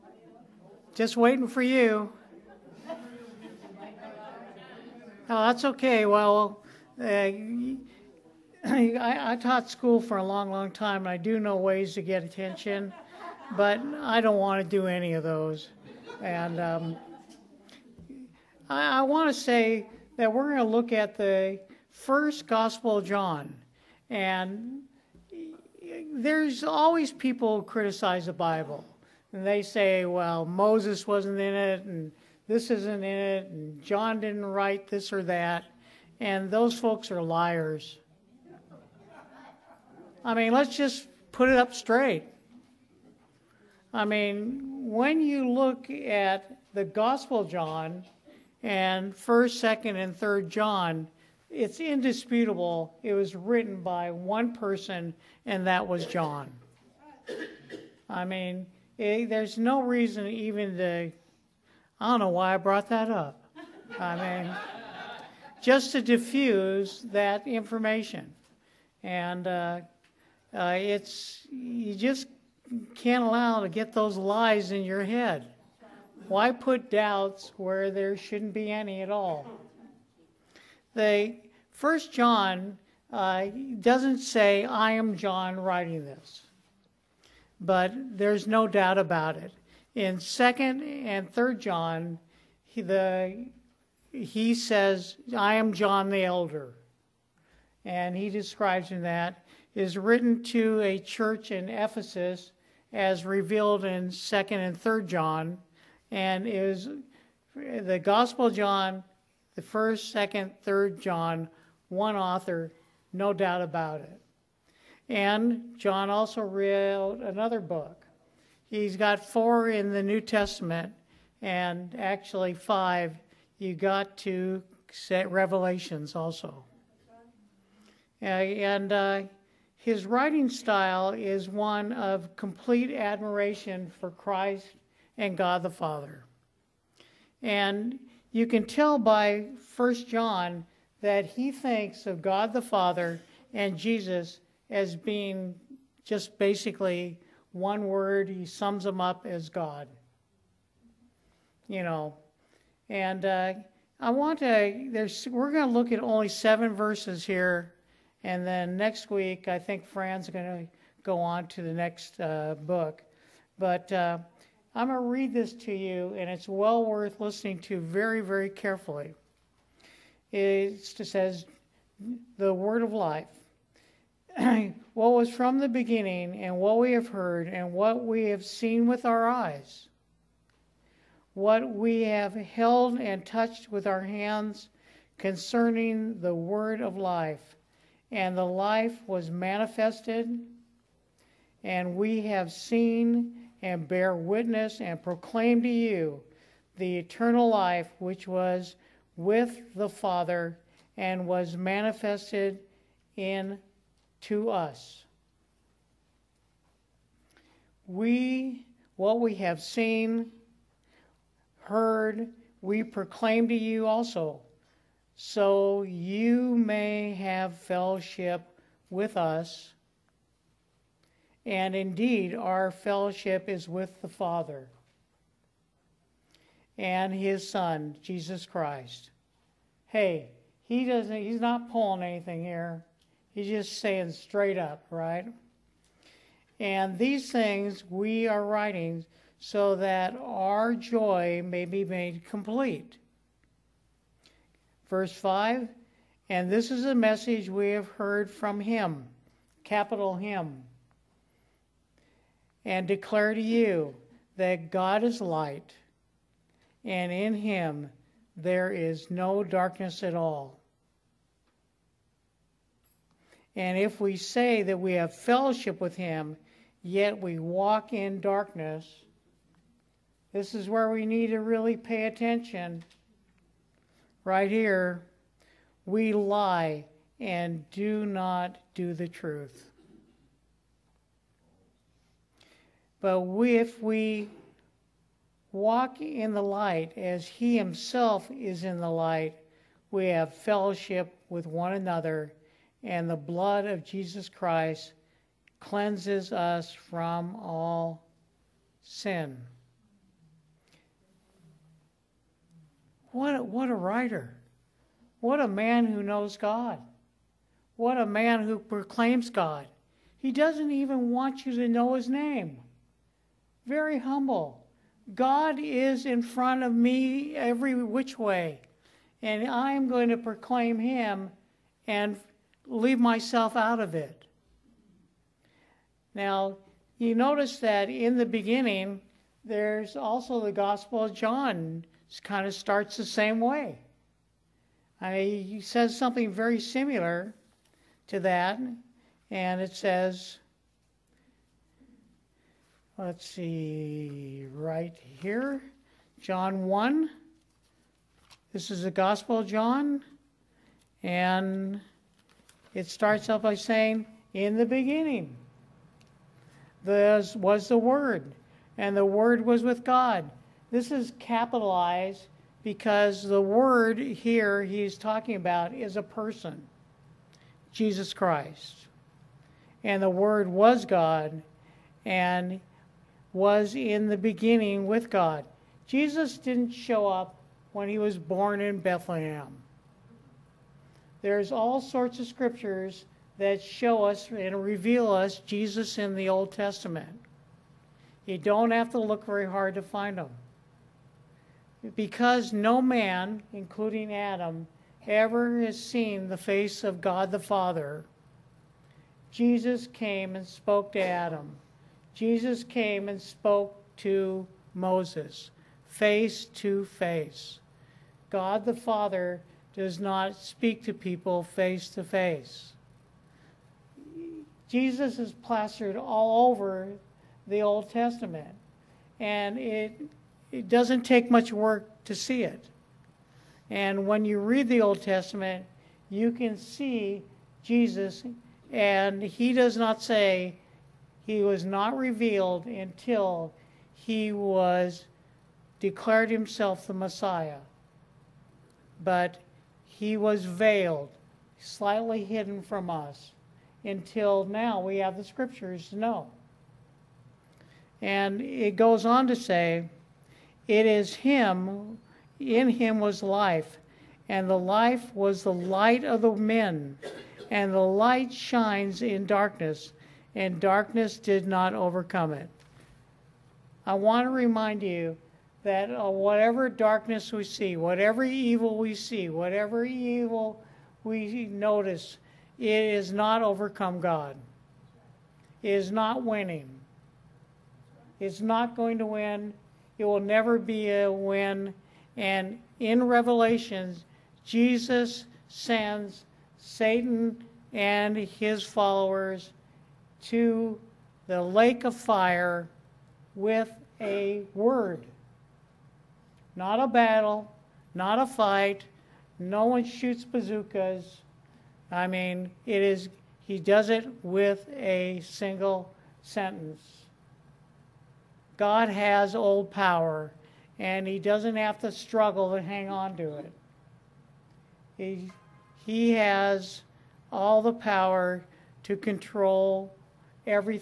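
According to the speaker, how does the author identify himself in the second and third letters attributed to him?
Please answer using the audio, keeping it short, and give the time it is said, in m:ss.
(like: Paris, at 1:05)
John the Elder, at 1:35.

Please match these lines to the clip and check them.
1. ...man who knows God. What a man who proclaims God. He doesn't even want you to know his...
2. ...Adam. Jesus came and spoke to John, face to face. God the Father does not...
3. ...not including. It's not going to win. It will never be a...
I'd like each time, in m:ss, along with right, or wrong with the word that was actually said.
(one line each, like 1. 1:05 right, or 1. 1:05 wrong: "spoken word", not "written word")
1. 5:05 right
2. 6:41 wrong: "Moses", not "John"
3. 7:55 wrong: "winning", not "including".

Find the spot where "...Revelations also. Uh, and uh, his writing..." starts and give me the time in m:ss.
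2:05.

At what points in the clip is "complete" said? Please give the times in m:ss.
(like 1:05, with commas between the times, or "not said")
2:12, 4:02.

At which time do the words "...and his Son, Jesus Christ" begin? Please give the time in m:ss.
3:46.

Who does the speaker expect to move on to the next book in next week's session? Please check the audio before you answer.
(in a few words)
Fran.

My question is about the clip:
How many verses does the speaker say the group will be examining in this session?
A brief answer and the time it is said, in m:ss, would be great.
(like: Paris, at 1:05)
7, at 2:36.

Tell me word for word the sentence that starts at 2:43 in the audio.
Uh, I'm going to read this to you, and it's well worth listening to very, very carefully.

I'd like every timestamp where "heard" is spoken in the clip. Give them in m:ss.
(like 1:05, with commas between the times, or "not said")
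2:57, 3:31, 4:07.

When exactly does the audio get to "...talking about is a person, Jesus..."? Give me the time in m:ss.
6:04.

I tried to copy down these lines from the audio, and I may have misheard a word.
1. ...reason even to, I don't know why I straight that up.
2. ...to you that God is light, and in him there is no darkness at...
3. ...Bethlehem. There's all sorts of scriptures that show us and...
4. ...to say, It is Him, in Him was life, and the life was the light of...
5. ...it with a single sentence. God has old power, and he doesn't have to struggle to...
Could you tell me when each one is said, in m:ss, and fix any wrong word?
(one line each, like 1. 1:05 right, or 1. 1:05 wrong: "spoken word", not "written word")
1. 0:59 wrong: "brought", not "straight"
2. 4:13 right
3. 6:18 right
4. 7:29 right
5. 8:23 right.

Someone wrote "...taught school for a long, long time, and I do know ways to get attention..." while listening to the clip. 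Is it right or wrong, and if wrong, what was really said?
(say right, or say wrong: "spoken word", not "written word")
right.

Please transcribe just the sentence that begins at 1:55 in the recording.
And John also wrote another book.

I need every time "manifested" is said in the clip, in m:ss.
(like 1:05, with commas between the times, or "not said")
3:09, 3:21.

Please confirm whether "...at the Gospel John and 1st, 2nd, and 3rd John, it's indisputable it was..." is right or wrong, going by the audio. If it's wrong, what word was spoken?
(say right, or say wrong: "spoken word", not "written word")
right.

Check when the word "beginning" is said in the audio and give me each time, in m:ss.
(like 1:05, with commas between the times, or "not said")
2:55, 5:28, 5:54, 6:14.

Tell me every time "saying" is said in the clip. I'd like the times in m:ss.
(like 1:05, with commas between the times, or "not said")
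3:53, 5:53.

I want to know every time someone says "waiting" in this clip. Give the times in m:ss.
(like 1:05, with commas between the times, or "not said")
0:01.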